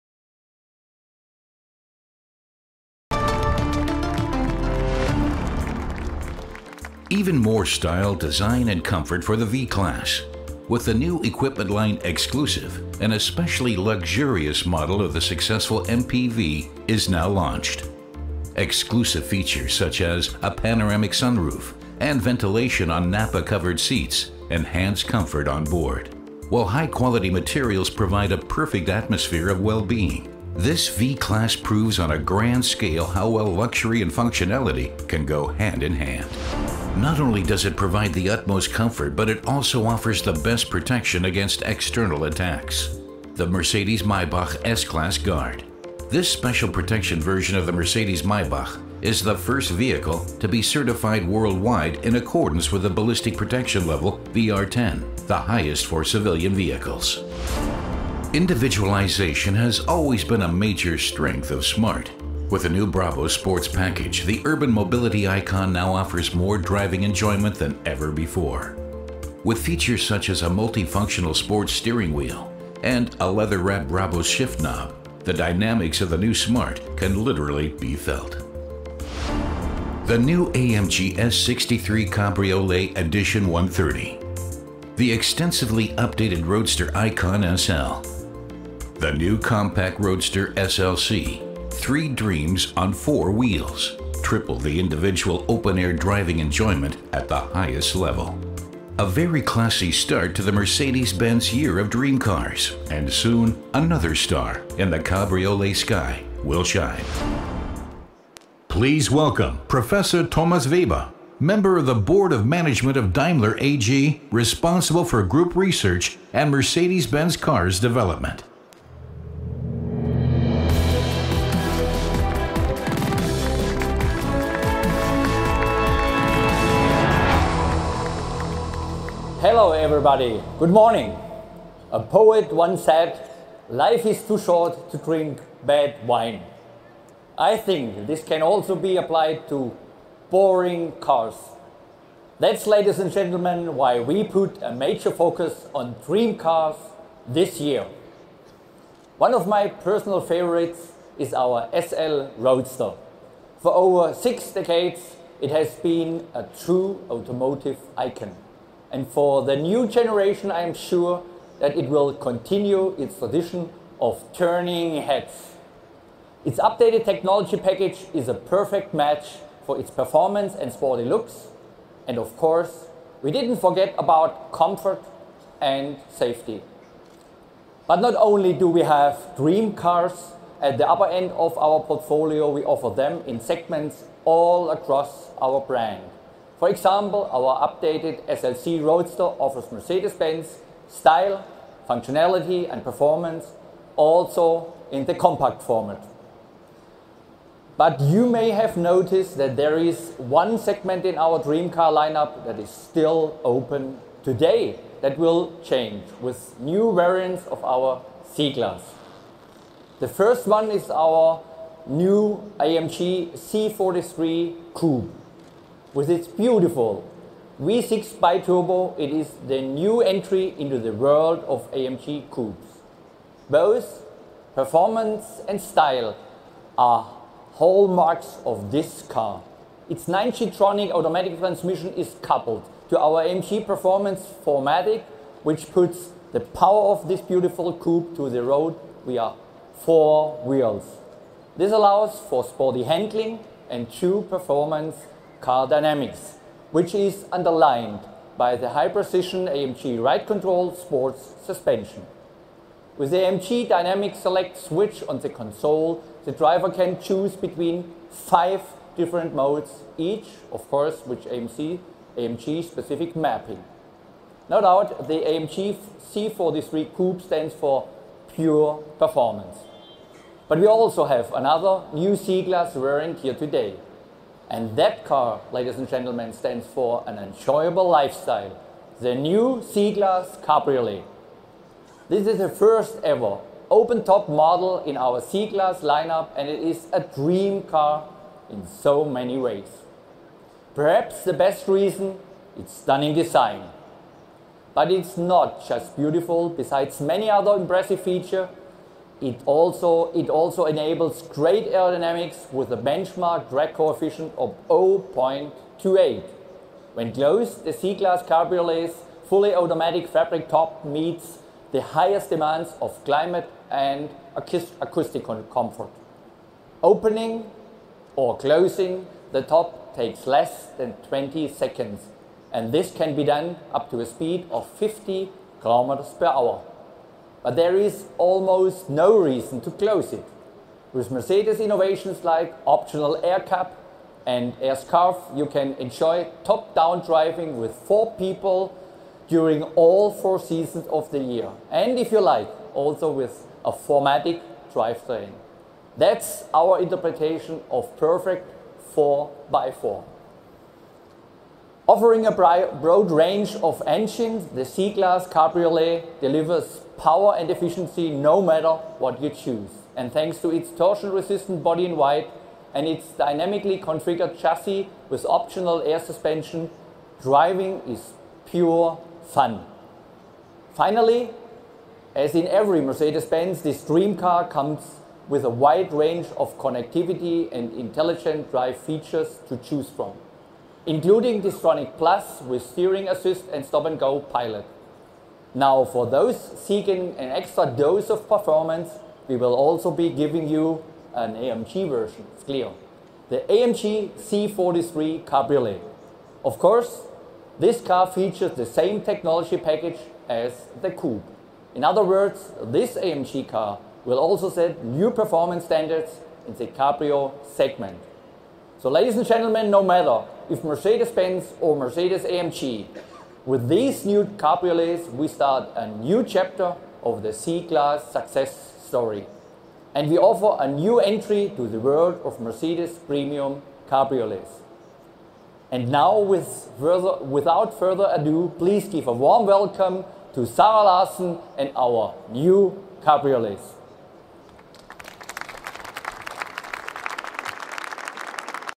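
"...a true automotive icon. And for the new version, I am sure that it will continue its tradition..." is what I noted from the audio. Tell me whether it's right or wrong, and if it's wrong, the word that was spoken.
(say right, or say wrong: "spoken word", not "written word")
wrong: "generation", not "version".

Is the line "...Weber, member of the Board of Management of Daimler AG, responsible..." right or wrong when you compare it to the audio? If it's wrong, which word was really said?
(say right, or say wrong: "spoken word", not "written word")
right.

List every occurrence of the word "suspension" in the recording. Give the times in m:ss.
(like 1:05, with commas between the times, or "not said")
4:11, 6:05.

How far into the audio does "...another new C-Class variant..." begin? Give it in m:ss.
4:31.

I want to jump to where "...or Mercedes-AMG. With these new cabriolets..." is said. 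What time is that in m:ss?
6:51.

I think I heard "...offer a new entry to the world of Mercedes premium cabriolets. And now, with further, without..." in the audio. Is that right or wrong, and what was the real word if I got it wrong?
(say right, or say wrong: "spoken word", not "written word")
right.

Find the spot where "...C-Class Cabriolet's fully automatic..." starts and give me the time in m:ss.
5:07.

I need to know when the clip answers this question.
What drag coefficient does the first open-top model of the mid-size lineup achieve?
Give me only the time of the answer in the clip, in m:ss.
5:04.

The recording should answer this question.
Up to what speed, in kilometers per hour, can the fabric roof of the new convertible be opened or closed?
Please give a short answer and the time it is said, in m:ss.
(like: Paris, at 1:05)
50, at 5:24.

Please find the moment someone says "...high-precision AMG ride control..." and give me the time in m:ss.
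4:08.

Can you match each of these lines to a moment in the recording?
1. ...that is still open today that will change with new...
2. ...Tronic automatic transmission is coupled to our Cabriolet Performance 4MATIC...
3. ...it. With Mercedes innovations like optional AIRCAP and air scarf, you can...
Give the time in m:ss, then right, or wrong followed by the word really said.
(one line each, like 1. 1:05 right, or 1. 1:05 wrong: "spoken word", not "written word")
1. 3:22 right
2. 3:50 wrong: "AMG", not "Cabriolet"
3. 5:30 right.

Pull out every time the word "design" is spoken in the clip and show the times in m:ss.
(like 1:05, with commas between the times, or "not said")
0:08, 4:53.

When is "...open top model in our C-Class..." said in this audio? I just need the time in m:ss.
4:43.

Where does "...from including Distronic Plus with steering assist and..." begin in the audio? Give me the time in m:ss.
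6:19.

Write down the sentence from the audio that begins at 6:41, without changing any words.
In other words, this AMG car will also set new performance standards in the Cabrio segment.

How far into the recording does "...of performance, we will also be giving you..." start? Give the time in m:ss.
6:28.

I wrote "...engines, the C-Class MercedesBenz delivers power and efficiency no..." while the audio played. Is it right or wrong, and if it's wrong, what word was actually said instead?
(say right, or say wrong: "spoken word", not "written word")
wrong: "Cabriolet", not "MercedesBenz".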